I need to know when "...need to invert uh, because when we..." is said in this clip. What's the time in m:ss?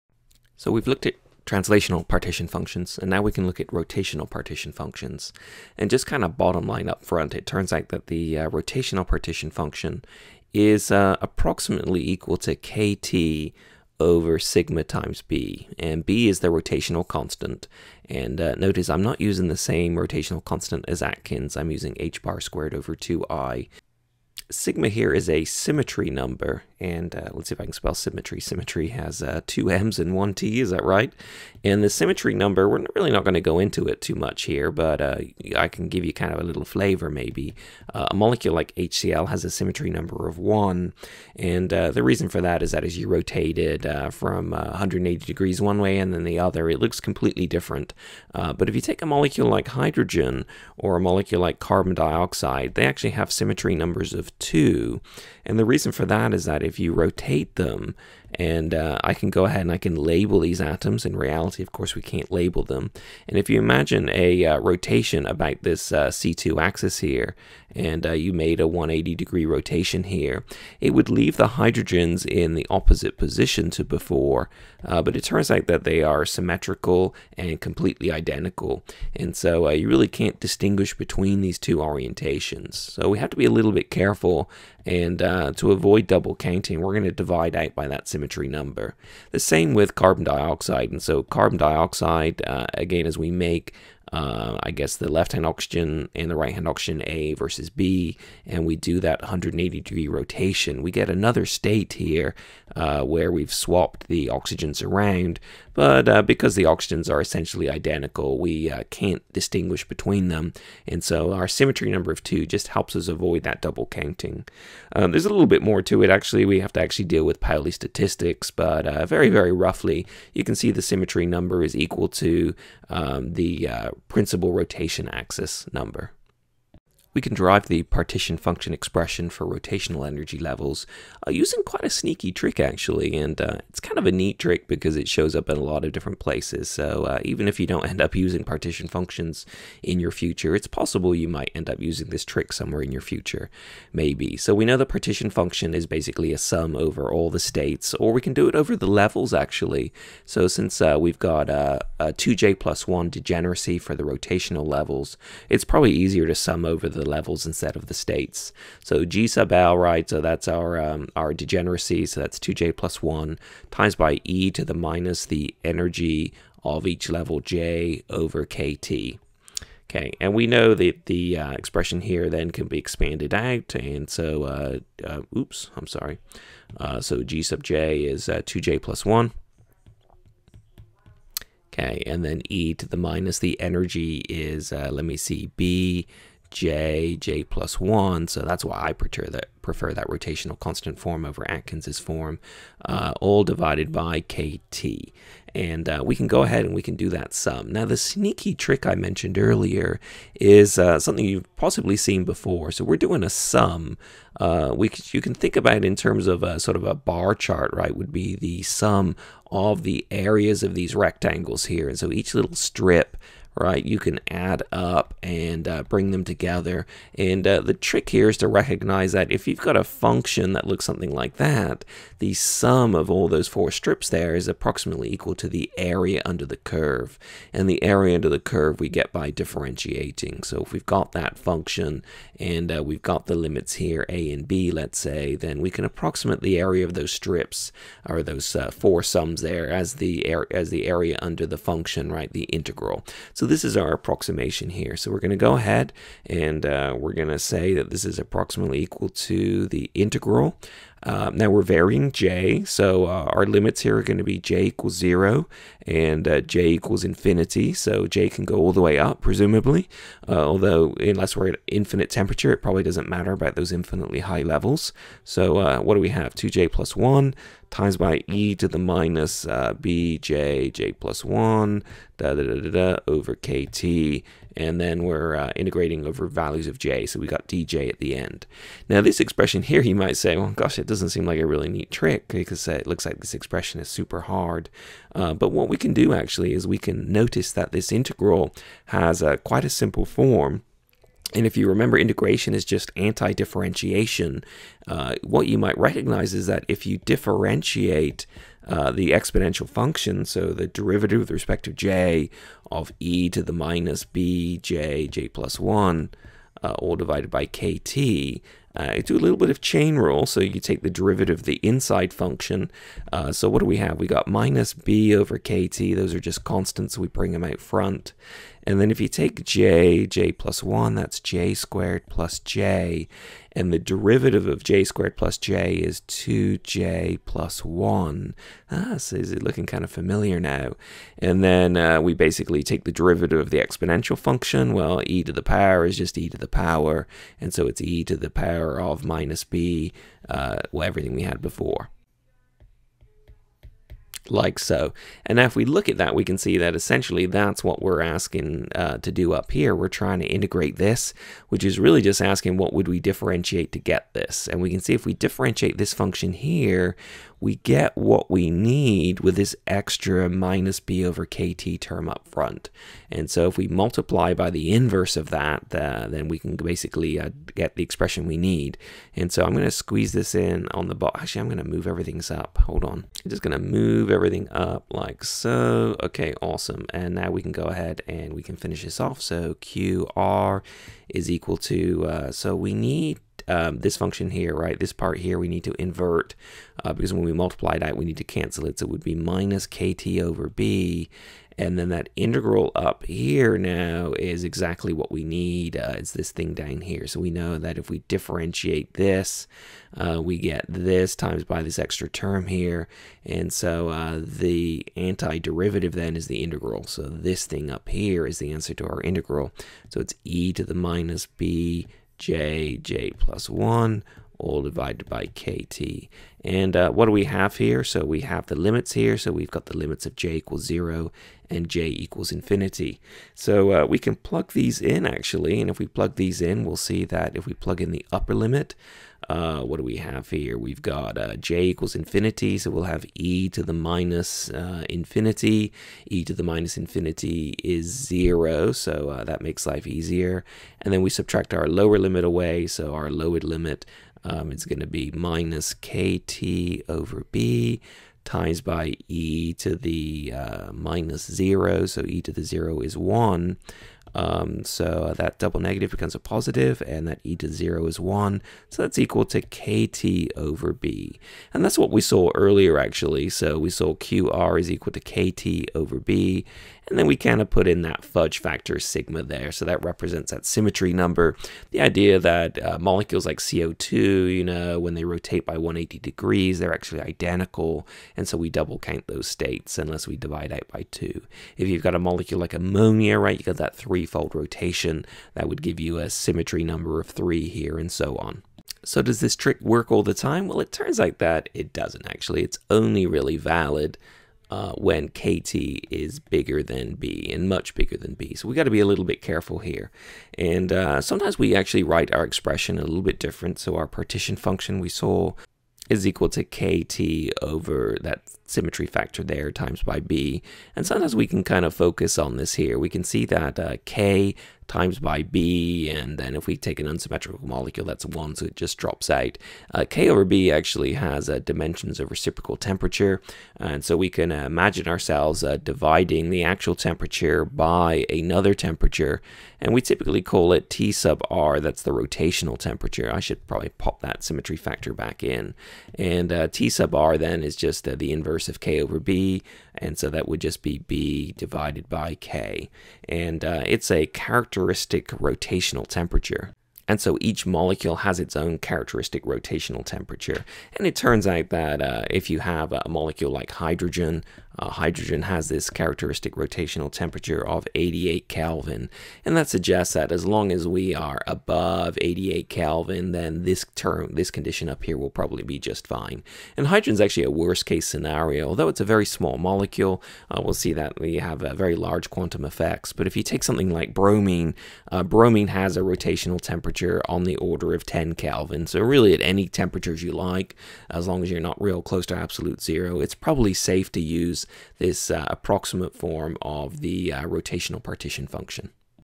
6:25.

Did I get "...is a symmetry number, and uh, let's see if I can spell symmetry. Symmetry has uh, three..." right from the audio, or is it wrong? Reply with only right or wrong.
wrong.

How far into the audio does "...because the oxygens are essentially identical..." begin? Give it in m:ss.
1:46.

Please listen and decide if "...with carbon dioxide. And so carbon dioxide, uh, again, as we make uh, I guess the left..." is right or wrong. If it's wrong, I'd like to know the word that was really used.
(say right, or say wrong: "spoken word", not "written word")
right.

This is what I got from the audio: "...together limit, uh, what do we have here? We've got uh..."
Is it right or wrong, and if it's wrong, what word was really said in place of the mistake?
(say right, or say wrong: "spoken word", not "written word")
wrong: "upper", not "together".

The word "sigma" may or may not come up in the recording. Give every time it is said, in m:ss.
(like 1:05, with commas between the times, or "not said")
0:14, 0:24, 7:48.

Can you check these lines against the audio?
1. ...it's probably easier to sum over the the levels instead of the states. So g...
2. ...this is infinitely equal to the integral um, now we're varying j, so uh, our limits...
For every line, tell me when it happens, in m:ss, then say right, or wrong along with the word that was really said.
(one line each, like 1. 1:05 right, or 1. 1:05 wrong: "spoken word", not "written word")
1. 2:35 right
2. 4:07 wrong: "approximately", not "infinitely".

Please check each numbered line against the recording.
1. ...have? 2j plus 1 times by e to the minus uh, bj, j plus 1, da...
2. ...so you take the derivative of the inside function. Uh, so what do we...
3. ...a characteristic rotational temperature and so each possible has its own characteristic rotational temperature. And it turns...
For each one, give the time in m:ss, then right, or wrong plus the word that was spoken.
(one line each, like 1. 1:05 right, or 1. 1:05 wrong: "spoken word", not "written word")
1. 4:26 right
2. 5:10 right
3. 9:03 wrong: "molecule", not "possible".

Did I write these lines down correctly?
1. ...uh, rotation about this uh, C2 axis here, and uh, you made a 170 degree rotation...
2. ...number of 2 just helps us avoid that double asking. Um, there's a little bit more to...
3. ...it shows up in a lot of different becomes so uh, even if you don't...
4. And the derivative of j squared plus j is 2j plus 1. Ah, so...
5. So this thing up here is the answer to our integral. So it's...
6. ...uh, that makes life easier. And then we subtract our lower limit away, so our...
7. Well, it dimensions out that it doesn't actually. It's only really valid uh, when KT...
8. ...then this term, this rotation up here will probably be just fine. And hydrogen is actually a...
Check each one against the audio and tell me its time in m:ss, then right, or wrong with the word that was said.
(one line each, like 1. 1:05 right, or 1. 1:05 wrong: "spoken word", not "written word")
1. 1:04 wrong: "180", not "170"
2. 1:51 wrong: "counting", not "asking"
3. 2:14 wrong: "places", not "becomes"
4. 5:23 right
5. 6:46 right
6. 7:19 right
7. 8:10 wrong: "turns", not "dimensions"
8. 9:23 wrong: "condition", not "rotation".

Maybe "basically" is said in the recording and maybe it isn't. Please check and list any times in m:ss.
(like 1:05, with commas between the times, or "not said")
2:25, 5:32, 6:06.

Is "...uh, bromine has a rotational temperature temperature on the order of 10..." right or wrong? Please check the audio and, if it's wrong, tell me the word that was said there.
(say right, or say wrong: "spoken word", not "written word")
right.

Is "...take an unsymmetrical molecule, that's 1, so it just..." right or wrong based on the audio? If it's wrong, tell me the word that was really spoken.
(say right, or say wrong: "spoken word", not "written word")
right.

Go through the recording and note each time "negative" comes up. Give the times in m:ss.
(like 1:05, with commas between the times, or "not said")
7:35.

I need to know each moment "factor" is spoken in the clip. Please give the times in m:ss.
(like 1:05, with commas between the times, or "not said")
7:48, 8:28, 8:54.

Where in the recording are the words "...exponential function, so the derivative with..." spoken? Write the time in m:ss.
4:59.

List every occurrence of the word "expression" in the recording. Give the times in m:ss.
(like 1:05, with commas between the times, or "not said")
2:08, 2:51, 4:39, 4:43, 6:07, 8:22.